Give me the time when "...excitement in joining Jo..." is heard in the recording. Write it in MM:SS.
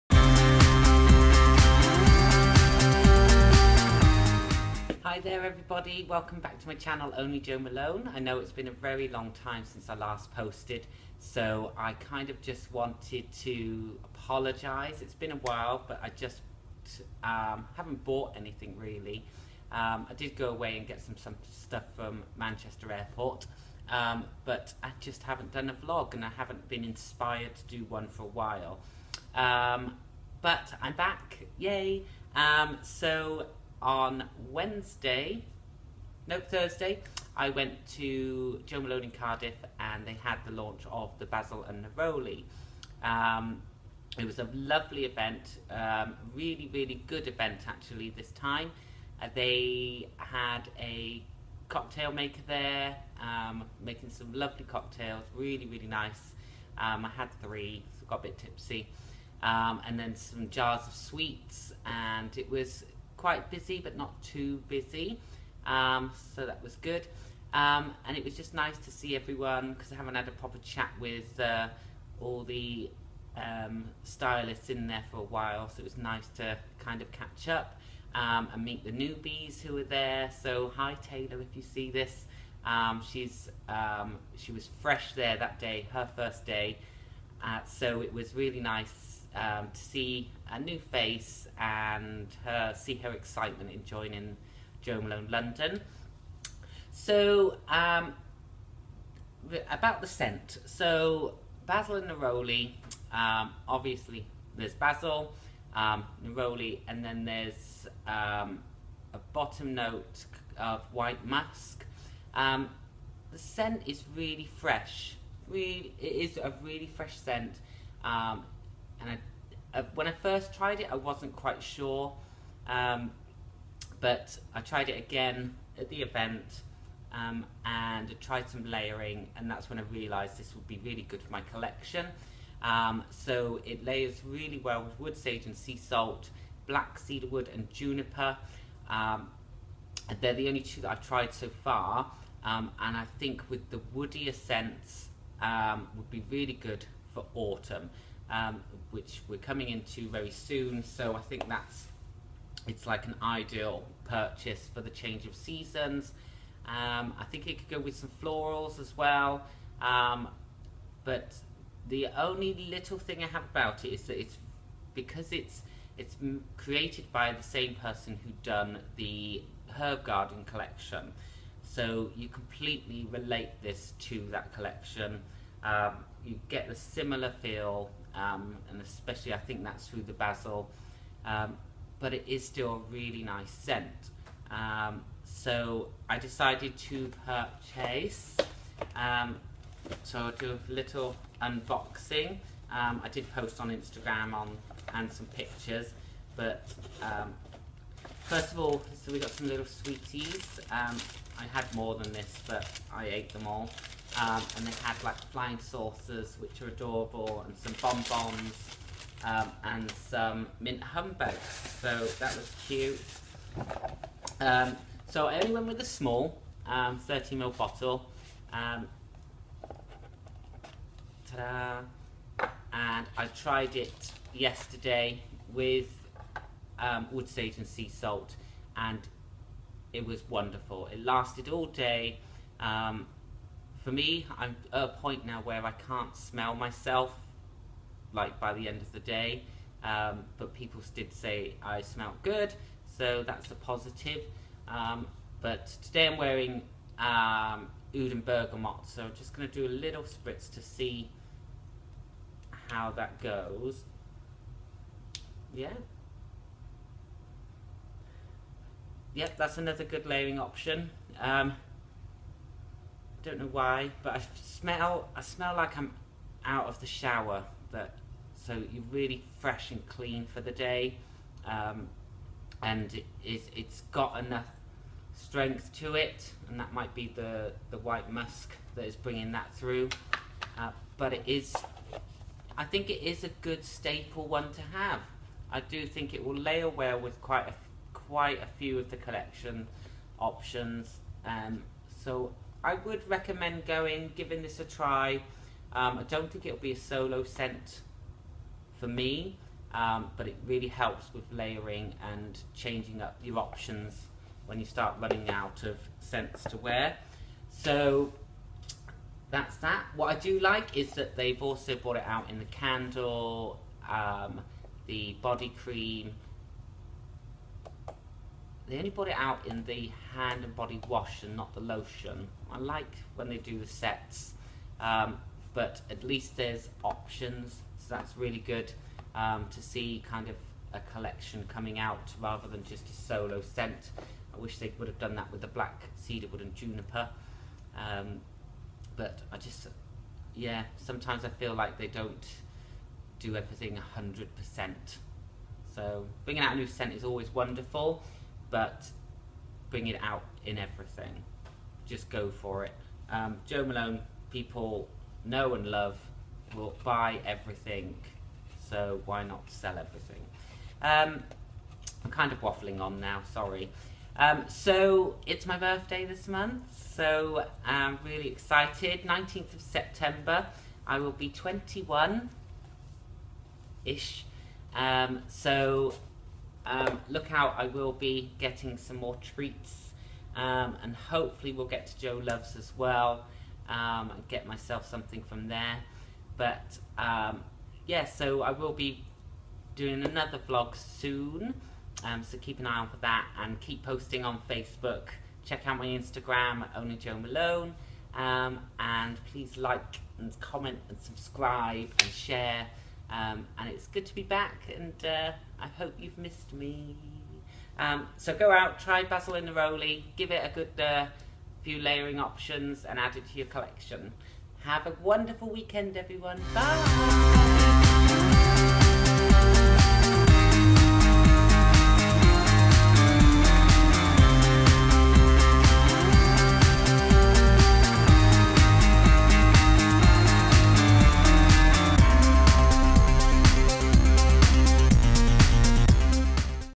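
01:33.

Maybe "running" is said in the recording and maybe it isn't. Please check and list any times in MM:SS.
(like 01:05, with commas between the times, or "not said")
05:04.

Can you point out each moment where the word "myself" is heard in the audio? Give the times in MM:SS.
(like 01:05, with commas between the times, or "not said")
03:56, 06:24.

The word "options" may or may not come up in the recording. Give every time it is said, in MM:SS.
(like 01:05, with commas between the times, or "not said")
04:20, 04:50, 05:03, 05:26, 06:52.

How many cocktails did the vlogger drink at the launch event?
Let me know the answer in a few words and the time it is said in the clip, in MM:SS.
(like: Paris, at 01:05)
3, at 00:57.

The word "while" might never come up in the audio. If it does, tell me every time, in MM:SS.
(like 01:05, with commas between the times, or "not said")
00:15, 00:28, 01:15.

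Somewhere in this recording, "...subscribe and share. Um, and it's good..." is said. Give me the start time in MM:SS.
06:40.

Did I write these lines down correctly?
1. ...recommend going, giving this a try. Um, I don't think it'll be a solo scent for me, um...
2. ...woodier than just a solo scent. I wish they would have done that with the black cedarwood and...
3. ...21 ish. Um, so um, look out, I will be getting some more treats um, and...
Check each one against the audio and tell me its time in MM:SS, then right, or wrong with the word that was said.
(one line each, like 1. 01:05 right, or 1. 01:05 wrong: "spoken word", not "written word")
1. 04:53 right
2. 05:32 wrong: "rather", not "woodier"
3. 06:11 right.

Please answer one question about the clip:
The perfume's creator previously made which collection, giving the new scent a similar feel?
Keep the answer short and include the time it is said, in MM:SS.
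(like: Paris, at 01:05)
herb garden collection, at 02:49.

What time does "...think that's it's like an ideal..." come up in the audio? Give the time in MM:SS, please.
02:31.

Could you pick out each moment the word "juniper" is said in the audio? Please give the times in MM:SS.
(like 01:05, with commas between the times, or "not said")
02:17, 05:36.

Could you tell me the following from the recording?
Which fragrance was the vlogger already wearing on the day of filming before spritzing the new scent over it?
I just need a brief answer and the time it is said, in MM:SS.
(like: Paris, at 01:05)
Oud Bergamot, at 04:07.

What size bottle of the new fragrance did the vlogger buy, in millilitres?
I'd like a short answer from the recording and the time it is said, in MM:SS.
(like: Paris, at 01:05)
30ml, at 03:36.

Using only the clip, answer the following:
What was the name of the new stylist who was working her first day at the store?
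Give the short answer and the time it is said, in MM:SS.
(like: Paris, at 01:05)
Taylor, at 01:21.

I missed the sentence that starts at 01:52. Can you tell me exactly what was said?
Um, the scent is really fresh.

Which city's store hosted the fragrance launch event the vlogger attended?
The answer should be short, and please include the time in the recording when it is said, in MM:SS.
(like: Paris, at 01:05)
Cardiff, at 00:39.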